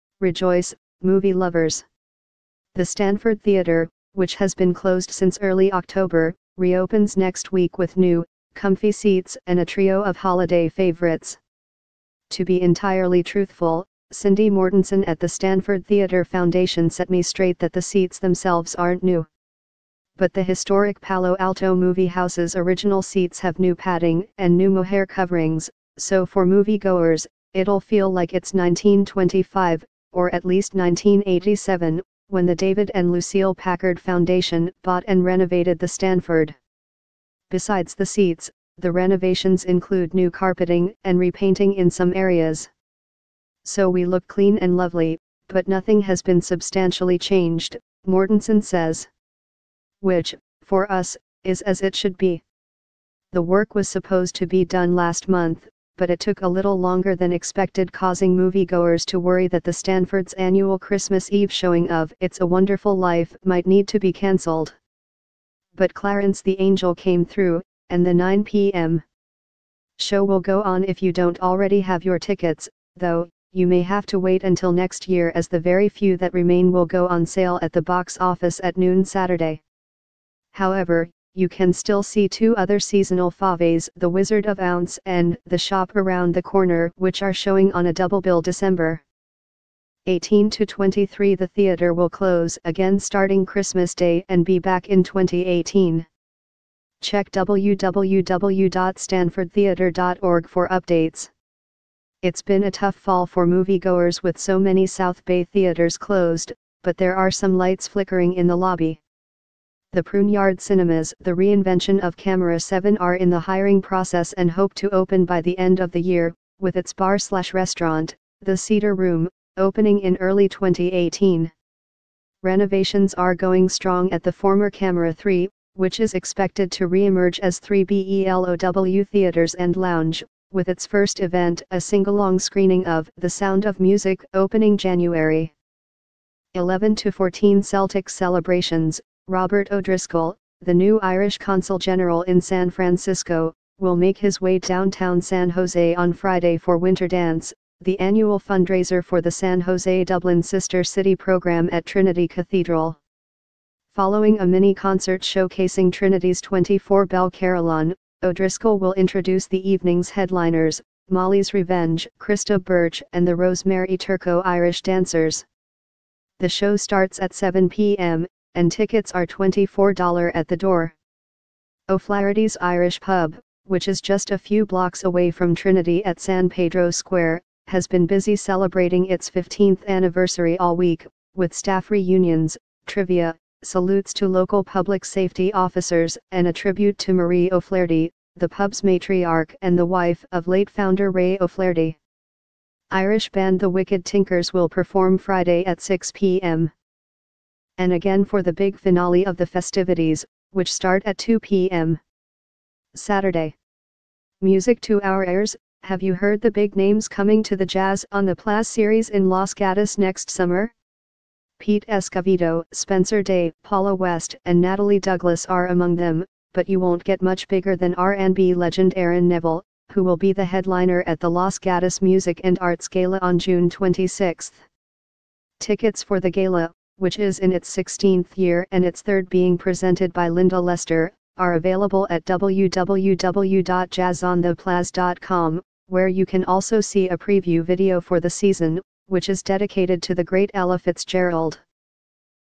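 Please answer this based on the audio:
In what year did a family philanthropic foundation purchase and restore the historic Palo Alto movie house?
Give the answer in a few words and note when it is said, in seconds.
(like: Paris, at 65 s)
1987, at 30 s.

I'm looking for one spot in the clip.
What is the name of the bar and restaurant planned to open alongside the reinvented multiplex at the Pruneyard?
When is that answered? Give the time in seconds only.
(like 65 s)
118 s.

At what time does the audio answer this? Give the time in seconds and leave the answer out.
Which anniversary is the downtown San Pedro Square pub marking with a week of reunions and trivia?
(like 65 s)
179 s.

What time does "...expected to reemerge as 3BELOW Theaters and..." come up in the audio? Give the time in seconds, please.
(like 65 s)
126 s.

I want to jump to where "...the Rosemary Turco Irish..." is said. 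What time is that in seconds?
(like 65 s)
163 s.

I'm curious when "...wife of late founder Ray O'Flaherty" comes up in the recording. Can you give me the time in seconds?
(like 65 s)
189 s.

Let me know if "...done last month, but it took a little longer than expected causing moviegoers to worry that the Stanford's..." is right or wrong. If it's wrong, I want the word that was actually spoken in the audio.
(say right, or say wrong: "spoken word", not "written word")
right.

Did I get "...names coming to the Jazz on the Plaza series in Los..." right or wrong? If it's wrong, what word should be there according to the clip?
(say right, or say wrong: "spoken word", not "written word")
right.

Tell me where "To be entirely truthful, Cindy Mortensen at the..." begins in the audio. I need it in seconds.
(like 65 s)
12 s.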